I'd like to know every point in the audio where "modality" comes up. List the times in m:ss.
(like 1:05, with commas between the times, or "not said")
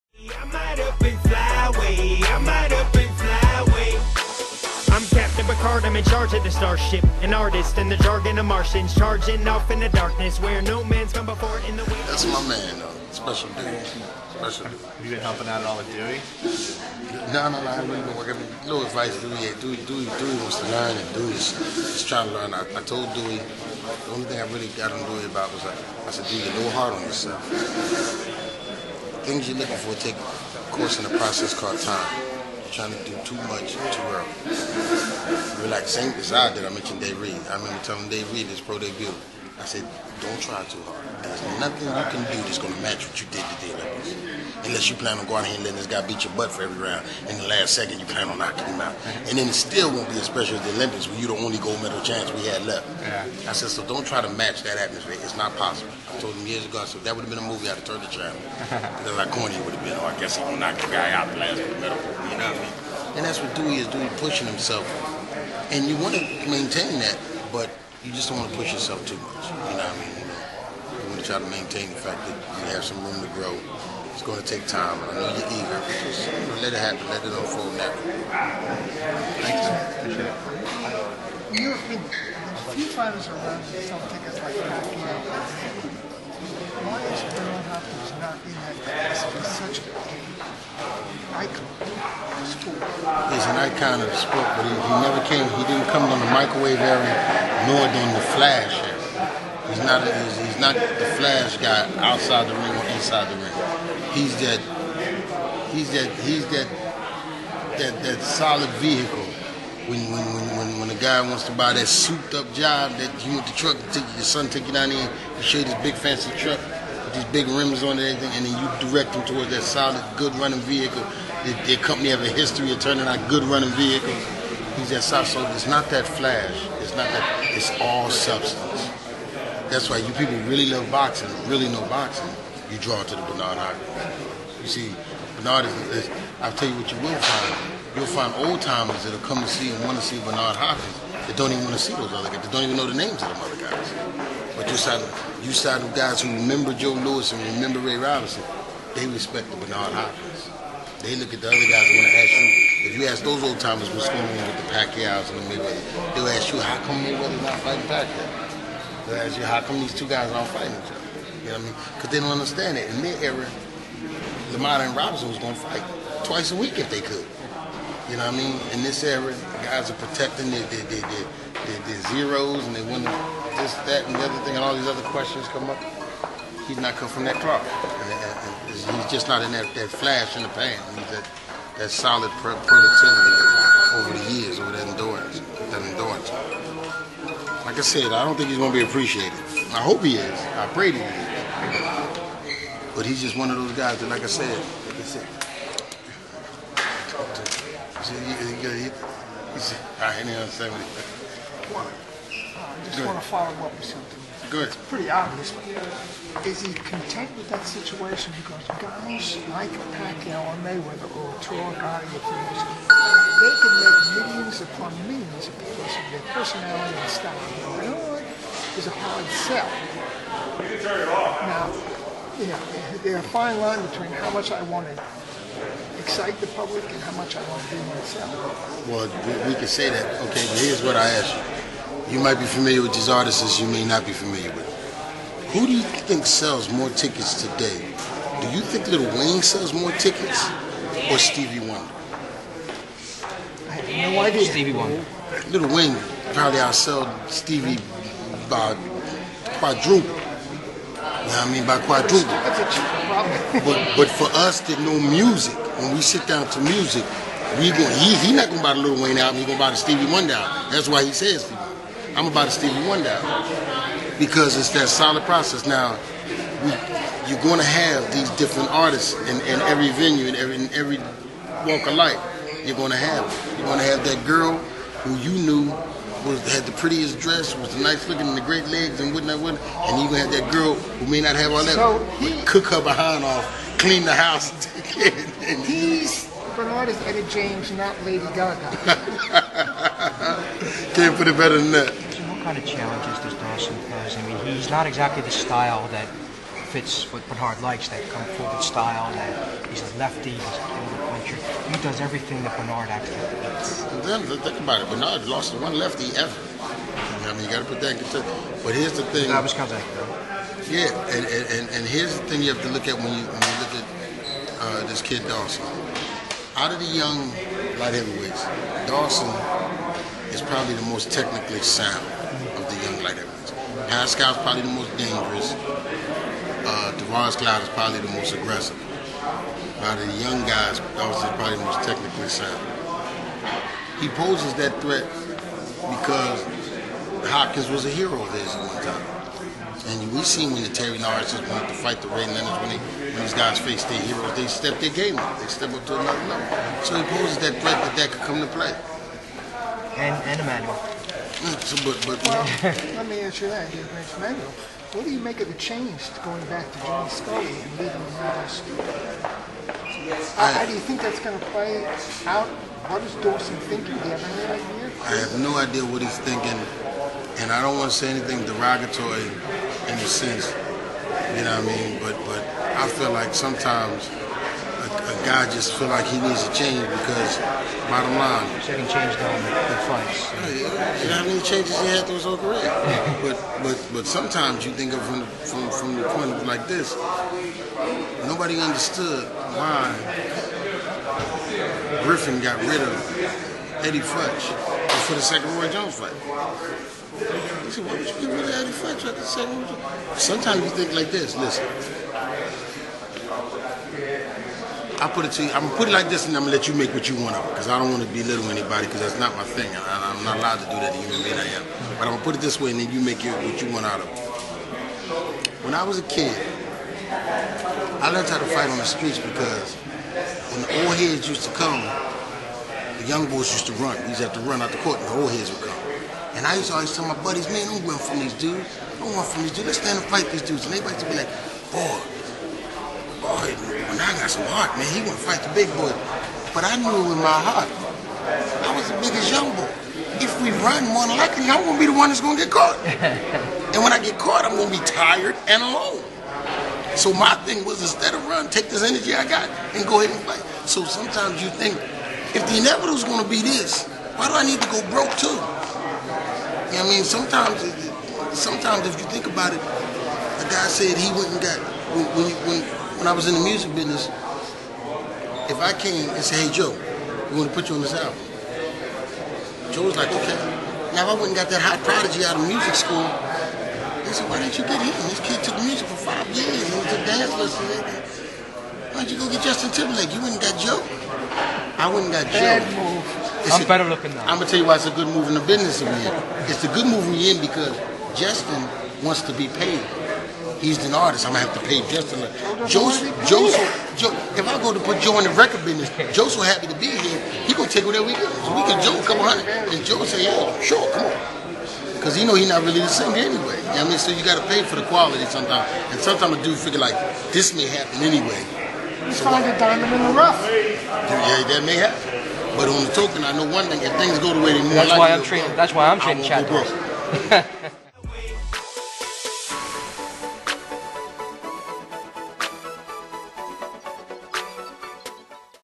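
not said.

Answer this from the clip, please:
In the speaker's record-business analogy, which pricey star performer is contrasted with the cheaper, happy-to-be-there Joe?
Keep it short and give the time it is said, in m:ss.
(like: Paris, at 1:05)
Justin Timberlake, at 7:59.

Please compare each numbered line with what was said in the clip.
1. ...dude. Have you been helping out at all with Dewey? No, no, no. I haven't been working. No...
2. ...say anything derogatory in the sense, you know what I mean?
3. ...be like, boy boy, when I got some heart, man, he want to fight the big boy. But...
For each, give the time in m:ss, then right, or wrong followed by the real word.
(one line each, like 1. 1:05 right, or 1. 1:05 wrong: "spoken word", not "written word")
1. 0:14 right
2. 6:07 right
3. 7:11 right.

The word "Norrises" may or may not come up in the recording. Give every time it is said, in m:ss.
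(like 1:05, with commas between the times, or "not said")
5:40.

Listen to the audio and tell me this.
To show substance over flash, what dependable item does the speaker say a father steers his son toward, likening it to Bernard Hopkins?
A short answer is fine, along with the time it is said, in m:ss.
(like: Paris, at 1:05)
solid good running vehicle, at 1:59.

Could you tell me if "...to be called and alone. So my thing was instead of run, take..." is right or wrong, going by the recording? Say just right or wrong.
wrong.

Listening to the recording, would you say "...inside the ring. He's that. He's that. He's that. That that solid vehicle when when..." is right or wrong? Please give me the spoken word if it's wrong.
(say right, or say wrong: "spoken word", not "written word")
right.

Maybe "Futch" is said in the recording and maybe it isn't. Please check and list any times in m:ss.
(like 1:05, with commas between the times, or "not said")
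6:33, 6:38.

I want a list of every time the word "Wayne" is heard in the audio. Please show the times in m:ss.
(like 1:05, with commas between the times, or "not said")
3:59, 4:05, 4:19.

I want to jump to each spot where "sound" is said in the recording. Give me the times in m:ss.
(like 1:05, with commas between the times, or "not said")
5:21, 5:32.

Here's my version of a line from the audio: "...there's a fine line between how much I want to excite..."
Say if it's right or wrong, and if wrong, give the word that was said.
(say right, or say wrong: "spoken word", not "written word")
right.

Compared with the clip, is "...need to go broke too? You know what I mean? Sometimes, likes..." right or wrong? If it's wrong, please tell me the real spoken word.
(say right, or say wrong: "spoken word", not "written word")
wrong: "sometimes", not "likes".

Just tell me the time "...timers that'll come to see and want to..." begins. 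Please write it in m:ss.
2:18.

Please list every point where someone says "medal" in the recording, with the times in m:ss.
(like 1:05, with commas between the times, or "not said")
0:51, 1:01.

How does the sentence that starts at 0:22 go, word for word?
I, I told Dewey, the only thing I really got on Dewey about was I.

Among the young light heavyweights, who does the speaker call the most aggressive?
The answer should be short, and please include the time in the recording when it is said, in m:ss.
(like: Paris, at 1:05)
Tavoris Cloud, at 5:26.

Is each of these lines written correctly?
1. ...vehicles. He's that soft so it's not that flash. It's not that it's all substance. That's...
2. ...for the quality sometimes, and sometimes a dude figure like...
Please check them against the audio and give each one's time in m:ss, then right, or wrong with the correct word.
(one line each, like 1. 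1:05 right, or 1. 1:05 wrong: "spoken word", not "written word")
1. 2:03 right
2. 8:24 right.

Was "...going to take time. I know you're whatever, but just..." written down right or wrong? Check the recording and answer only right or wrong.
wrong.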